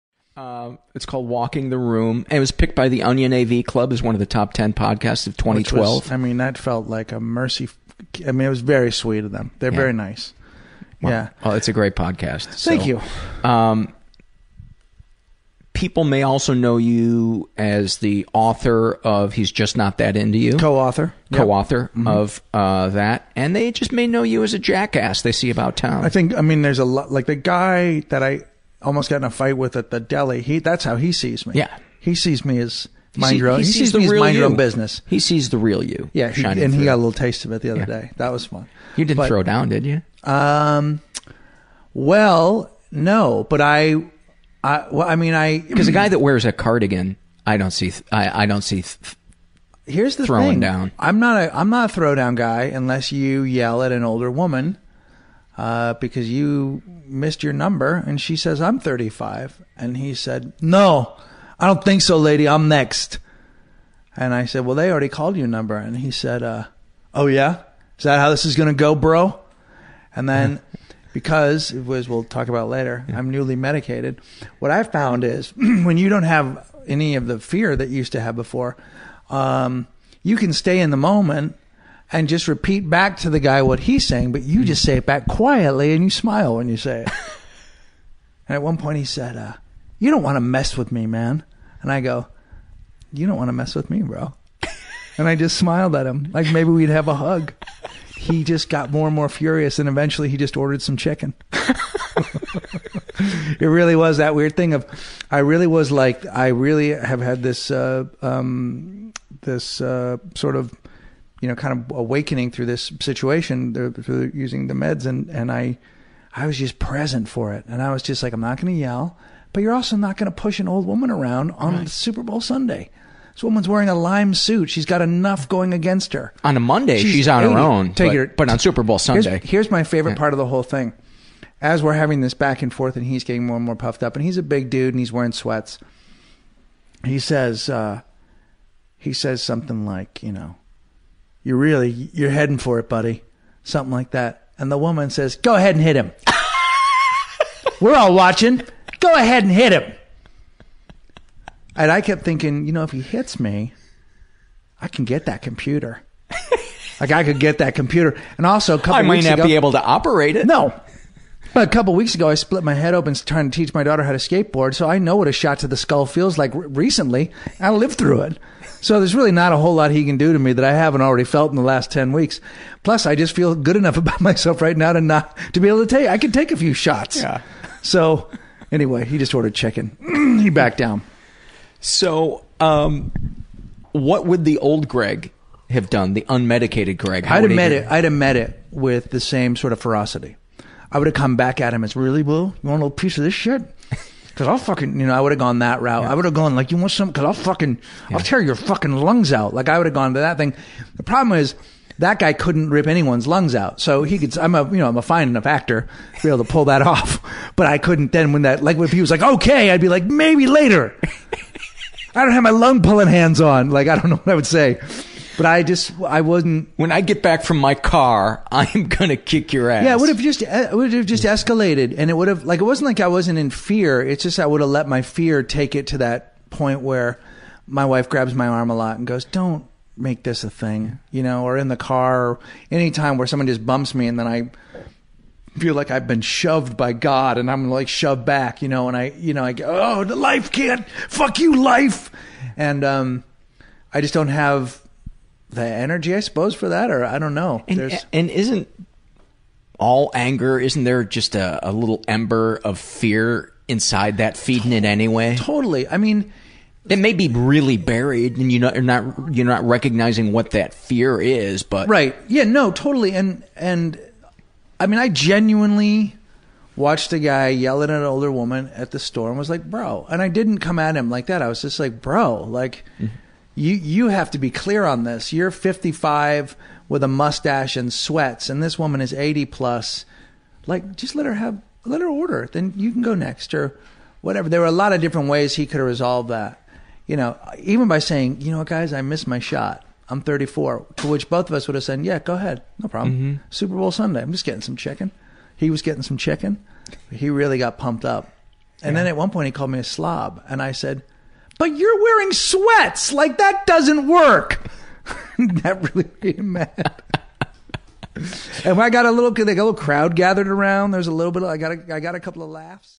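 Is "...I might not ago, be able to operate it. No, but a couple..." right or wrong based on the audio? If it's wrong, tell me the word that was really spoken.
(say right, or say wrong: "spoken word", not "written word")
right.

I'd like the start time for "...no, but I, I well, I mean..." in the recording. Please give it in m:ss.
0:42.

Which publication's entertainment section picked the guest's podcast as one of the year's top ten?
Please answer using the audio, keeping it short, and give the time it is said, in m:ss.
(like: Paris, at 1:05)
Onion AV Club, at 0:03.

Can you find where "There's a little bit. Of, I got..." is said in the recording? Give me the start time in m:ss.
5:10.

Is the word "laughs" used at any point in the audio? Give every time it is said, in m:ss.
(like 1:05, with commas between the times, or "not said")
5:12.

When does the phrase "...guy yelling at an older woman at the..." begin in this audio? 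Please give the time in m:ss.
4:27.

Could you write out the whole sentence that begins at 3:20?
The problem is that guy couldn't rip anyone's lungs out.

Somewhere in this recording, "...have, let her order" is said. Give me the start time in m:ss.
4:41.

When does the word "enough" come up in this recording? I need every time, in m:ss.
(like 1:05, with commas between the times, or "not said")
2:05, 2:53, 3:25.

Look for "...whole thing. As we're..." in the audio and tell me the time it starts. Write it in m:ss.
2:10.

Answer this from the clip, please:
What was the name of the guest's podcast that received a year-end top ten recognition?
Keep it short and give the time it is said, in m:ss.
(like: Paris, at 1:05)
Walking the Room, at 0:01.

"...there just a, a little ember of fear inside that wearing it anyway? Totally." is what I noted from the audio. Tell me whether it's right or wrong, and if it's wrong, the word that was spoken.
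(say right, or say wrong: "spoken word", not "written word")
wrong: "feeding", not "wearing".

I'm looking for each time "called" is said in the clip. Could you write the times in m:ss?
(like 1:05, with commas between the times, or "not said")
0:01, 1:05, 4:59.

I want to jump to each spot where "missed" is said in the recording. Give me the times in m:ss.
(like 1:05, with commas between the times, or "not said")
0:57, 4:49.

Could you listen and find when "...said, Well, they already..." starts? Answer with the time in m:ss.
1:04.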